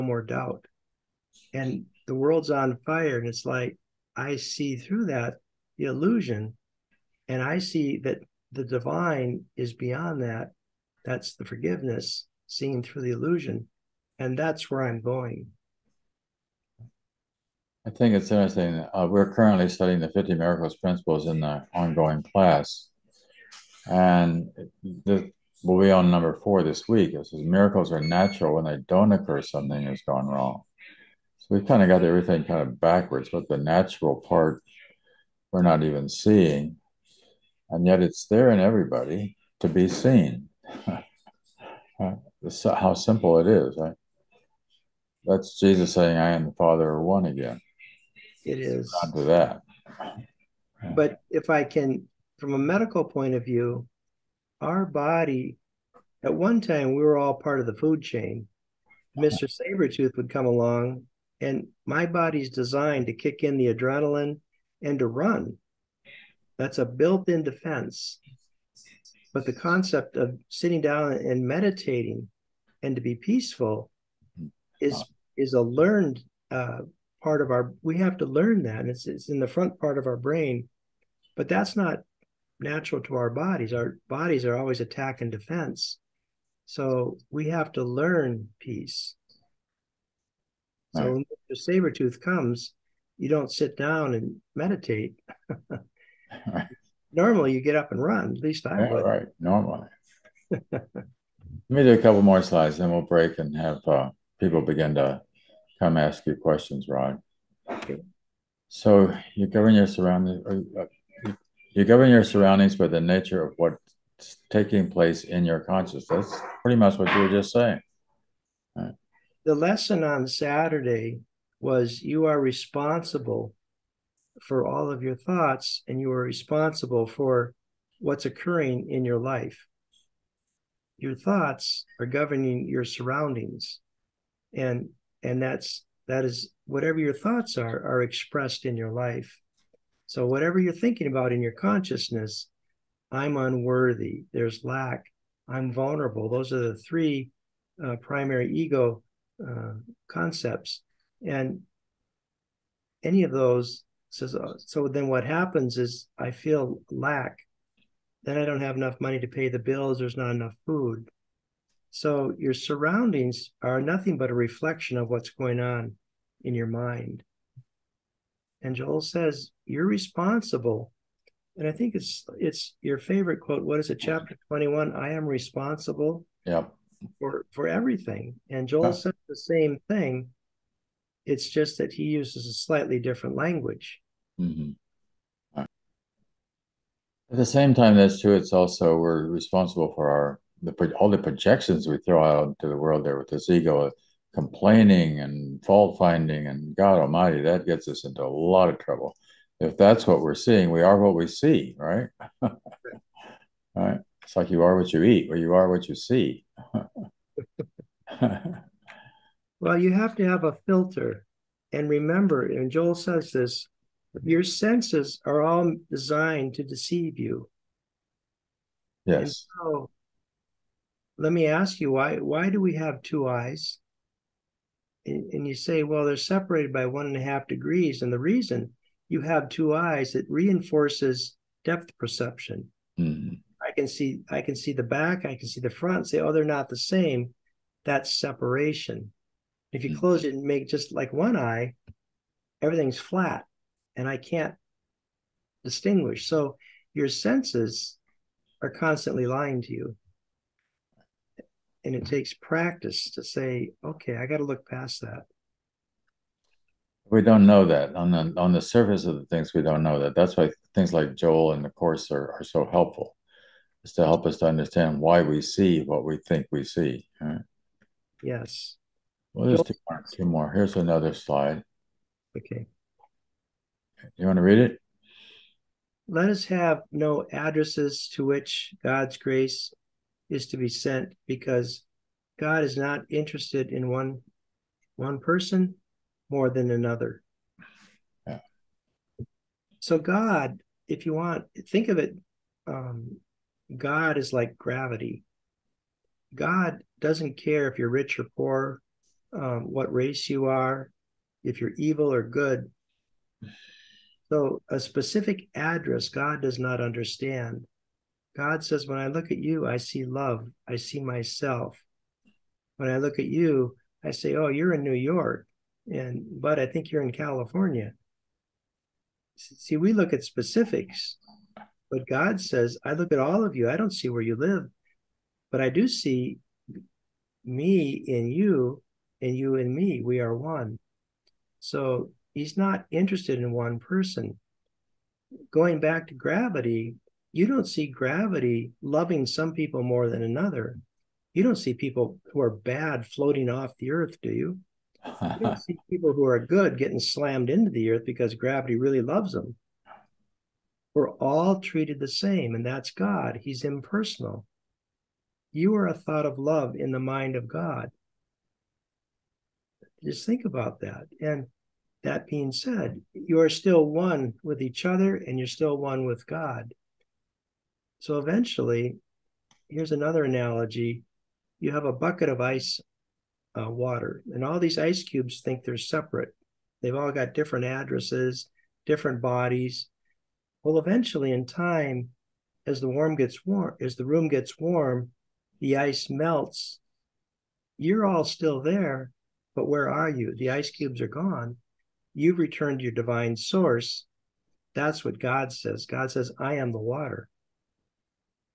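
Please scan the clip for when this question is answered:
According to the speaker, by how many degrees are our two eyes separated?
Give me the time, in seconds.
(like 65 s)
226 s.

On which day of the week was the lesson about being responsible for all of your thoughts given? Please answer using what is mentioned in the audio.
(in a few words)
Saturday.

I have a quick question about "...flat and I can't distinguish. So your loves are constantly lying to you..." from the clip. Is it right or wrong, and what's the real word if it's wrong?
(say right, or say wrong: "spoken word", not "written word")
wrong: "senses", not "loves".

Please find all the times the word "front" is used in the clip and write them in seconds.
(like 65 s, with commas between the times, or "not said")
79 s, 235 s.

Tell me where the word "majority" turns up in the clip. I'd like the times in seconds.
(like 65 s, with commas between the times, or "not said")
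not said.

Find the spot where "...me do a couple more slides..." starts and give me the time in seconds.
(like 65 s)
101 s.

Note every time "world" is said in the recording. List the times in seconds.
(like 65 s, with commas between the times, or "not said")
2 s, 192 s.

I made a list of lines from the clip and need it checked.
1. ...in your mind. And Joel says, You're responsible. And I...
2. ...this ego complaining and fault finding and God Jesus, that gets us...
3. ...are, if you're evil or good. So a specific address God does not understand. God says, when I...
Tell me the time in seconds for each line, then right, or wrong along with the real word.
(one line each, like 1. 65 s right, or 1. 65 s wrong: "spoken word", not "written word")
1. 166 s right
2. 193 s wrong: "Almighty", not "Jesus"
3. 300 s right.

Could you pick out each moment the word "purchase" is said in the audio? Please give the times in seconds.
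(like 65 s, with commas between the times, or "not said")
not said.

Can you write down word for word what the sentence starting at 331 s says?
So he's not interested in one person.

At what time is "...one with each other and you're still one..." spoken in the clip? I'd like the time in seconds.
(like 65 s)
363 s.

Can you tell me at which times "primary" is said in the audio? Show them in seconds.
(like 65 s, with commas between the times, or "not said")
147 s.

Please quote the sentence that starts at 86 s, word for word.
So we have to learn peace.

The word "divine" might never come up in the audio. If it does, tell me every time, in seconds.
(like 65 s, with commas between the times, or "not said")
8 s, 392 s.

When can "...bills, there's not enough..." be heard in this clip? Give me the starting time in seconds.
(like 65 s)
159 s.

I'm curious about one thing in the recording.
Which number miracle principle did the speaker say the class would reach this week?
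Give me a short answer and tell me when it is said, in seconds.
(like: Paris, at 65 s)
4, at 26 s.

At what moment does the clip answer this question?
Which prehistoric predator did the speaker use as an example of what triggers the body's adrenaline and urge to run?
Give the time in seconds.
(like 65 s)
59 s.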